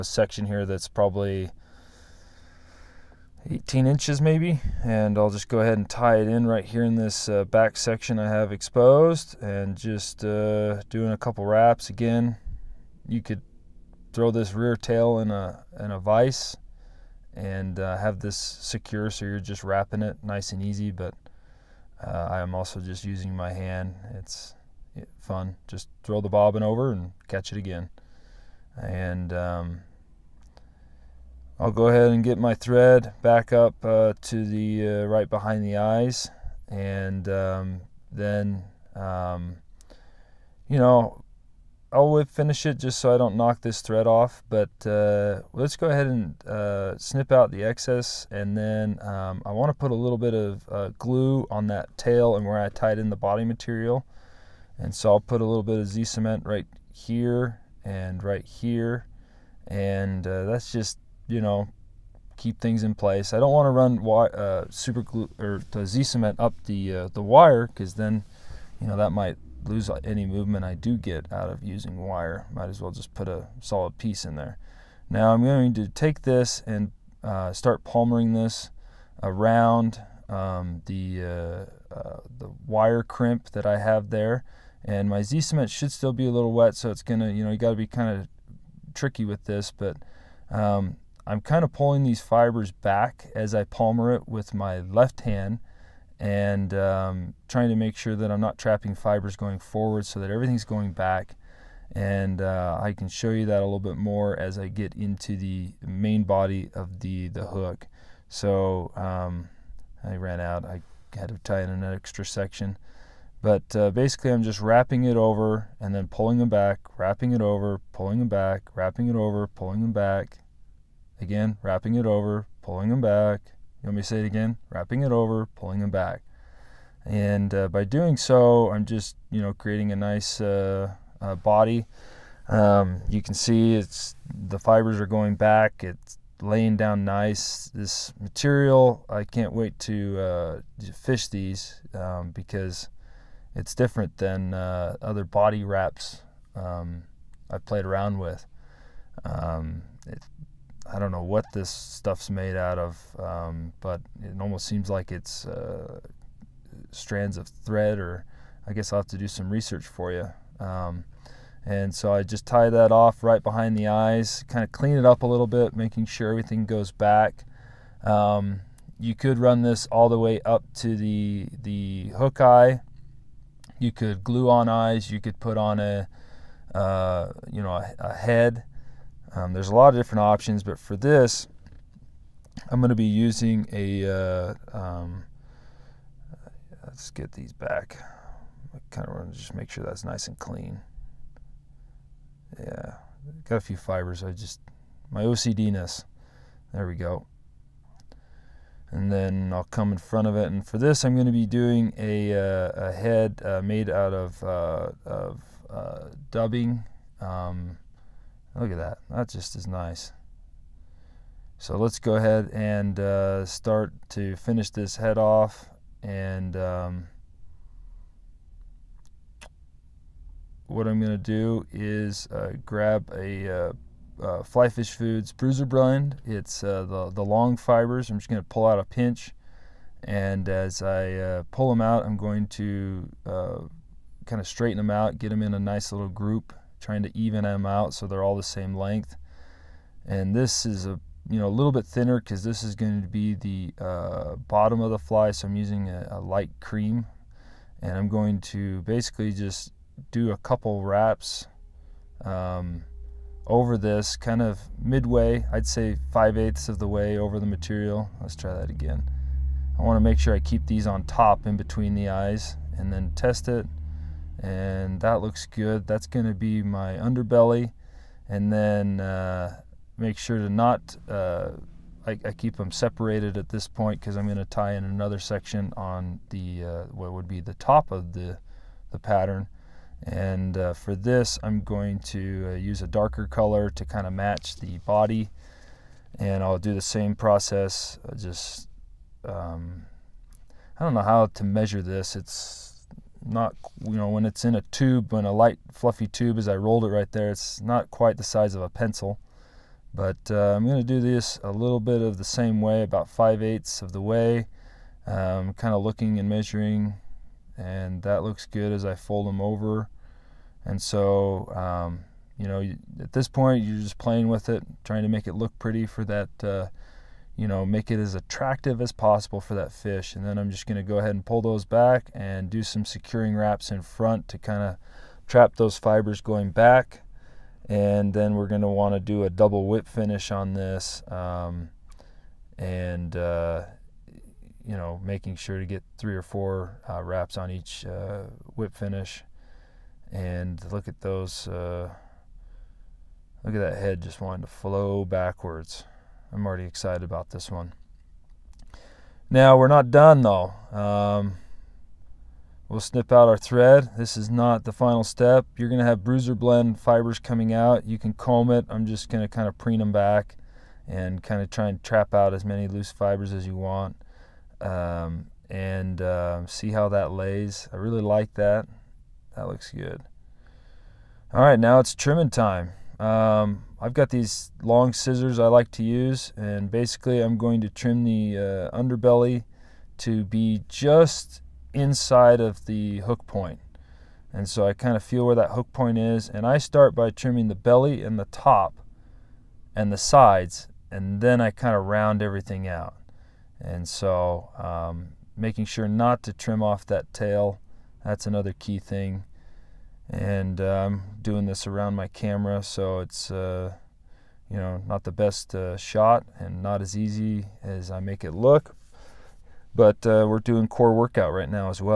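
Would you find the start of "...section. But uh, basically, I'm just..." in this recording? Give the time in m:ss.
1:52.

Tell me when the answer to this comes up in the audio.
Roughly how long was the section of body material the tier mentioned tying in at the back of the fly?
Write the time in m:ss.
0:03.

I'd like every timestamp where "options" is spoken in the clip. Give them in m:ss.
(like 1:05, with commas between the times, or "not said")
3:00.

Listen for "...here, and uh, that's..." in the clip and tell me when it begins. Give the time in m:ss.
0:58.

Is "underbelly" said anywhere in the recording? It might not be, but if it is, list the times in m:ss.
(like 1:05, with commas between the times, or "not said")
4:26, 6:18.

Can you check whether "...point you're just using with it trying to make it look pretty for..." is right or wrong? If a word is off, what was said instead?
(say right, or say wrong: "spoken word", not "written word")
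wrong: "playing", not "using".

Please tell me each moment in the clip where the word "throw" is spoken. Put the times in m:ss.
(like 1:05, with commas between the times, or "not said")
0:14, 0:26.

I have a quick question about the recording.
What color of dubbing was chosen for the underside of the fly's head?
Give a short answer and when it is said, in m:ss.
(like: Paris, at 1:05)
light cream, at 4:06.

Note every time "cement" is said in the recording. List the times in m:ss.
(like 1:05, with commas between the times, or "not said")
0:56, 1:06, 1:25.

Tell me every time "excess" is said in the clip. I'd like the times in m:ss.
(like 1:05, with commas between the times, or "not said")
0:47.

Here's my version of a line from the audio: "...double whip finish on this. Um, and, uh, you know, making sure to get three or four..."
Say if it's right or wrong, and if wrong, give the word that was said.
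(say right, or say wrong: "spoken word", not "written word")
right.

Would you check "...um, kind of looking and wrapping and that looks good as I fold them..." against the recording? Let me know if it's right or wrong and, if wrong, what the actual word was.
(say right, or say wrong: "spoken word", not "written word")
wrong: "measuring", not "wrapping".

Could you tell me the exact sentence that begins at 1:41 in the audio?
And uh, I can show you that a little bit more as I get into the main body of the, the hook.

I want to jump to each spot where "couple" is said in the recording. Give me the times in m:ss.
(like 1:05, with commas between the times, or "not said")
0:11, 4:10.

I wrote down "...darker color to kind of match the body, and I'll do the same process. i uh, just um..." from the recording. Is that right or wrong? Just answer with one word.
right.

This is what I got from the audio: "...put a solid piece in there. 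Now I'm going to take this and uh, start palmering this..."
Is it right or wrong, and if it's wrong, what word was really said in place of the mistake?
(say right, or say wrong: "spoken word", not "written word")
right.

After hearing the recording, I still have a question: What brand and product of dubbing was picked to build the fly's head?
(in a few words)
Flyfish Foods Bruiser Blend.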